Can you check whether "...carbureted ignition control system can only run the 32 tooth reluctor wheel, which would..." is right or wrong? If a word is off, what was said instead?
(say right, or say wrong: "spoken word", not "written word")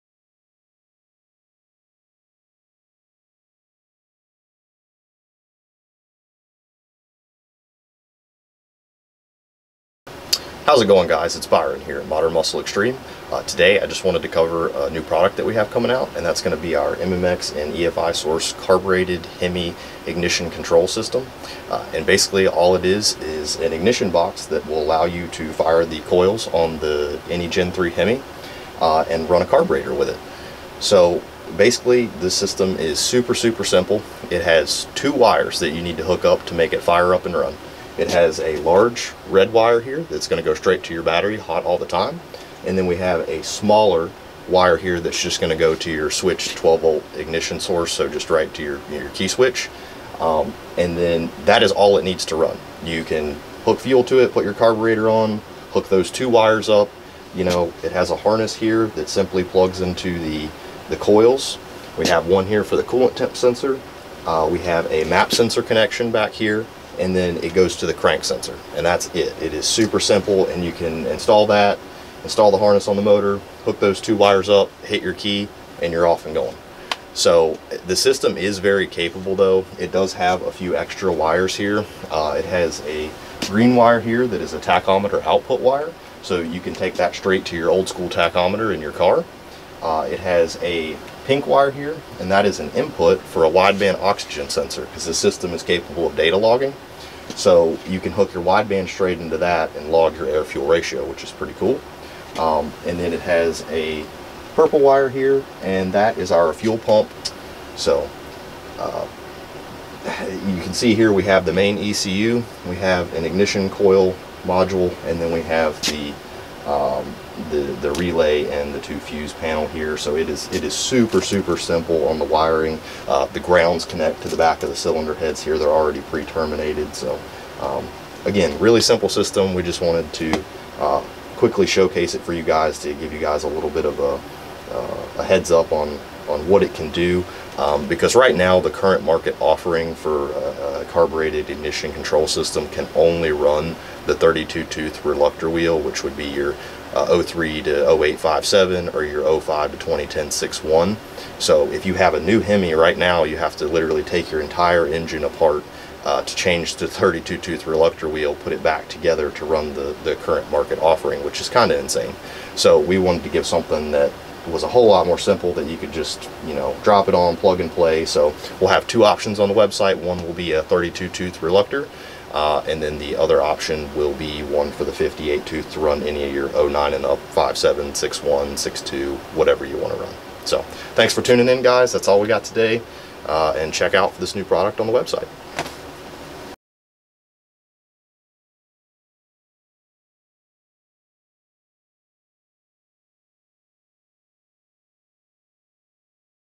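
right.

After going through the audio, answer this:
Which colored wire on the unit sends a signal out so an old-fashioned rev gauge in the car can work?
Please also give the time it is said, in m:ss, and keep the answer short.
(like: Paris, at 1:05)
green, at 1:23.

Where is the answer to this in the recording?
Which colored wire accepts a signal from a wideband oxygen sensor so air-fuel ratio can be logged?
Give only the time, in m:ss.
1:31.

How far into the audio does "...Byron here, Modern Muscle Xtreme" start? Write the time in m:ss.
0:11.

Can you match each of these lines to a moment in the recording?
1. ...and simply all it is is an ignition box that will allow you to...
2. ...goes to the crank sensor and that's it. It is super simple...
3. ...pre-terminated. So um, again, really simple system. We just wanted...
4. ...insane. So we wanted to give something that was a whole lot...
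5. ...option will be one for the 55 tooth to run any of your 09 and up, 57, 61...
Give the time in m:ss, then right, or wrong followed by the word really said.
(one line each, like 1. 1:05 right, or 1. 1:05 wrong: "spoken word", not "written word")
1. 0:21 wrong: "basically", not "simply"
2. 1:07 right
3. 2:06 right
4. 2:41 right
5. 2:53 wrong: "58", not "55".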